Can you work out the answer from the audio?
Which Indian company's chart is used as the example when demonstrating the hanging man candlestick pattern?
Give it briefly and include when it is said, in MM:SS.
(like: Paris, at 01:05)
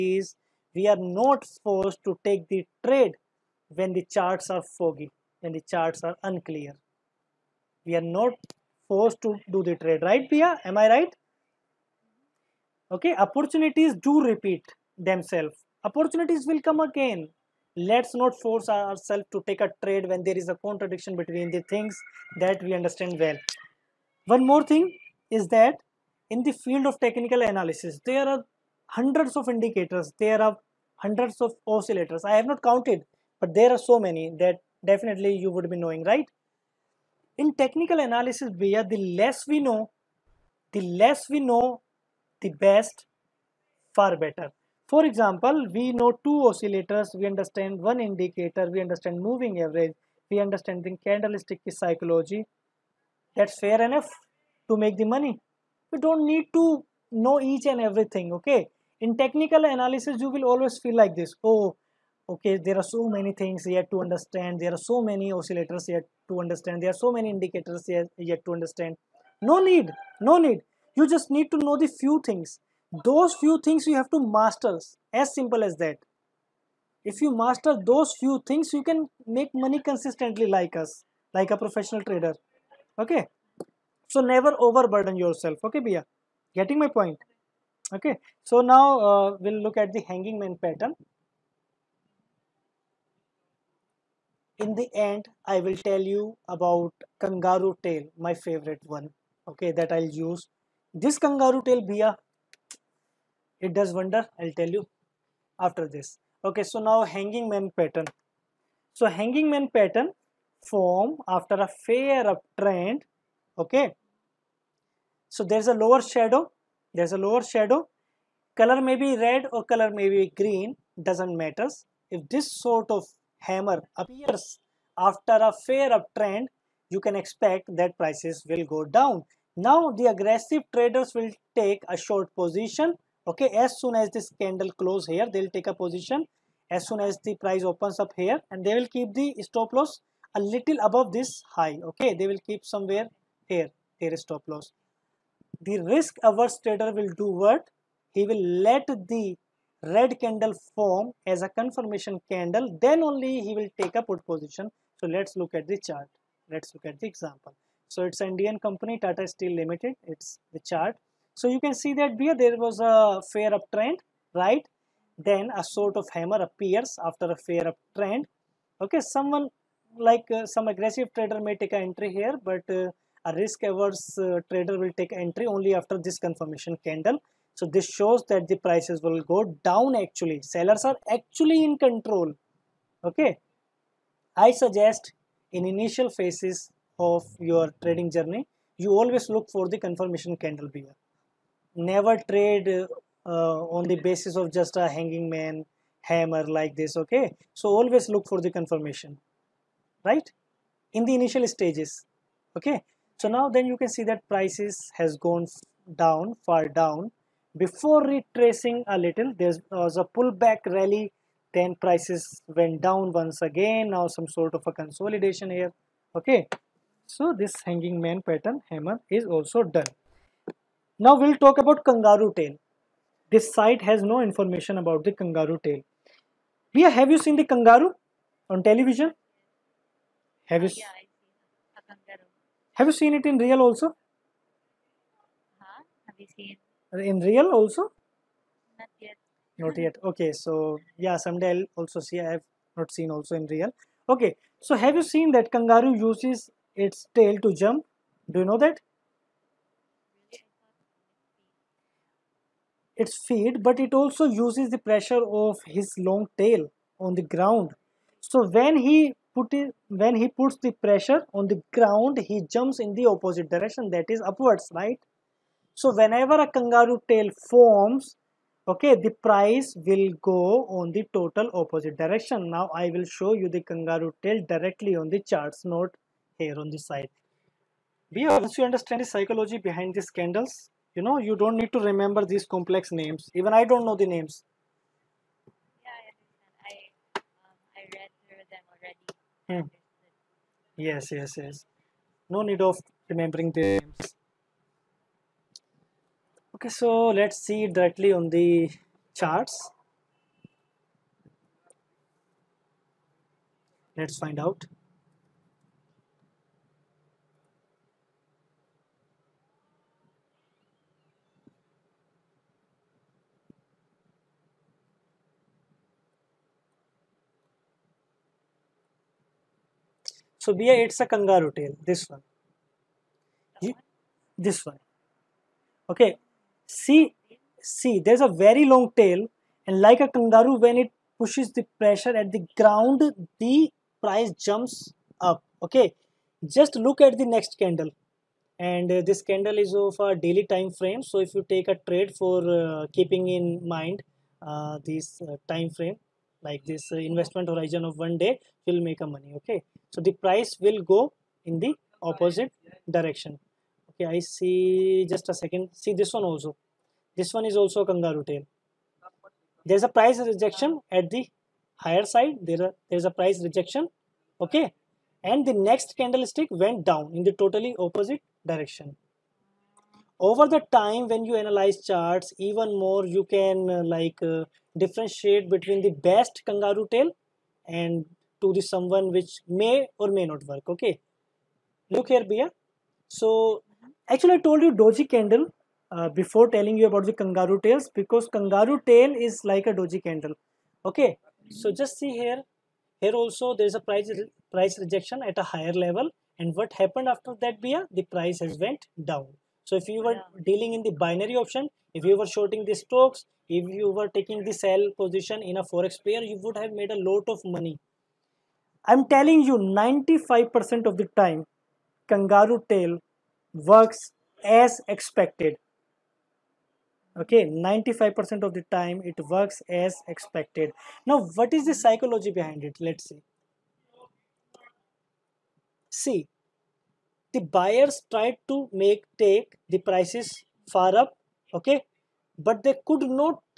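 Tata Steel Limited, at 02:39.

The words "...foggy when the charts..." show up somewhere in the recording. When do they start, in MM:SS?
00:04.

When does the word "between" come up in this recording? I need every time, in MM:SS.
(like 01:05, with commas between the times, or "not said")
00:21, 06:15.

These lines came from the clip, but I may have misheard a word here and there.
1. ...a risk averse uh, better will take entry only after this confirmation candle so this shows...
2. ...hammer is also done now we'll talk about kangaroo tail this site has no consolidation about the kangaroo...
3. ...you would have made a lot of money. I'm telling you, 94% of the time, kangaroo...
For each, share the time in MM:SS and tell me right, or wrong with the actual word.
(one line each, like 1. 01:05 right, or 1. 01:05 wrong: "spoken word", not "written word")
1. 02:53 wrong: "trader", not "better"
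2. 03:38 wrong: "information", not "consolidation"
3. 06:46 wrong: "95", not "94".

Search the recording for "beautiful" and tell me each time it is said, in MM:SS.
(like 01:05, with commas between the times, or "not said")
not said.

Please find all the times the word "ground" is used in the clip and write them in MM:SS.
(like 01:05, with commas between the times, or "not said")
04:17, 04:21, 05:32.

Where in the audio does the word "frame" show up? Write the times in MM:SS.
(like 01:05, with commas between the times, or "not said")
05:40, 05:45.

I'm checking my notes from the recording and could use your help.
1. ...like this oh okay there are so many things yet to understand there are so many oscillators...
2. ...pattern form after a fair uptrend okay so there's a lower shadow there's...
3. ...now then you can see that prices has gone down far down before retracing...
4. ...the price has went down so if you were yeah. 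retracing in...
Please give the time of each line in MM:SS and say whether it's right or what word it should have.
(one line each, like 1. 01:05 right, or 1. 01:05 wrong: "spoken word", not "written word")
1. 01:01 right
2. 01:49 right
3. 03:23 right
4. 06:37 wrong: "dealing", not "retracing".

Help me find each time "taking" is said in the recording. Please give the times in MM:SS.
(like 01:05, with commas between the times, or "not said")
06:44.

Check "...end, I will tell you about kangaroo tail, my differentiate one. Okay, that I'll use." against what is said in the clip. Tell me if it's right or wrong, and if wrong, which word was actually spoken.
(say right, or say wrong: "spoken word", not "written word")
wrong: "favorite", not "differentiate".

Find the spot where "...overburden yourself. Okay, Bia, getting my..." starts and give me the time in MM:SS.
01:24.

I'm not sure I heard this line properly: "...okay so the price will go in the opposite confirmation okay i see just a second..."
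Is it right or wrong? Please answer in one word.
wrong.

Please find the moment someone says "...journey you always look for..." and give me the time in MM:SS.
03:08.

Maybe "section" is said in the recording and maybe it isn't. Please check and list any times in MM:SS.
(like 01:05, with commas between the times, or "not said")
not said.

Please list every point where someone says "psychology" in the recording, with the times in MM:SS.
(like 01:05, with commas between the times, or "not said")
00:51, 04:39, 07:01.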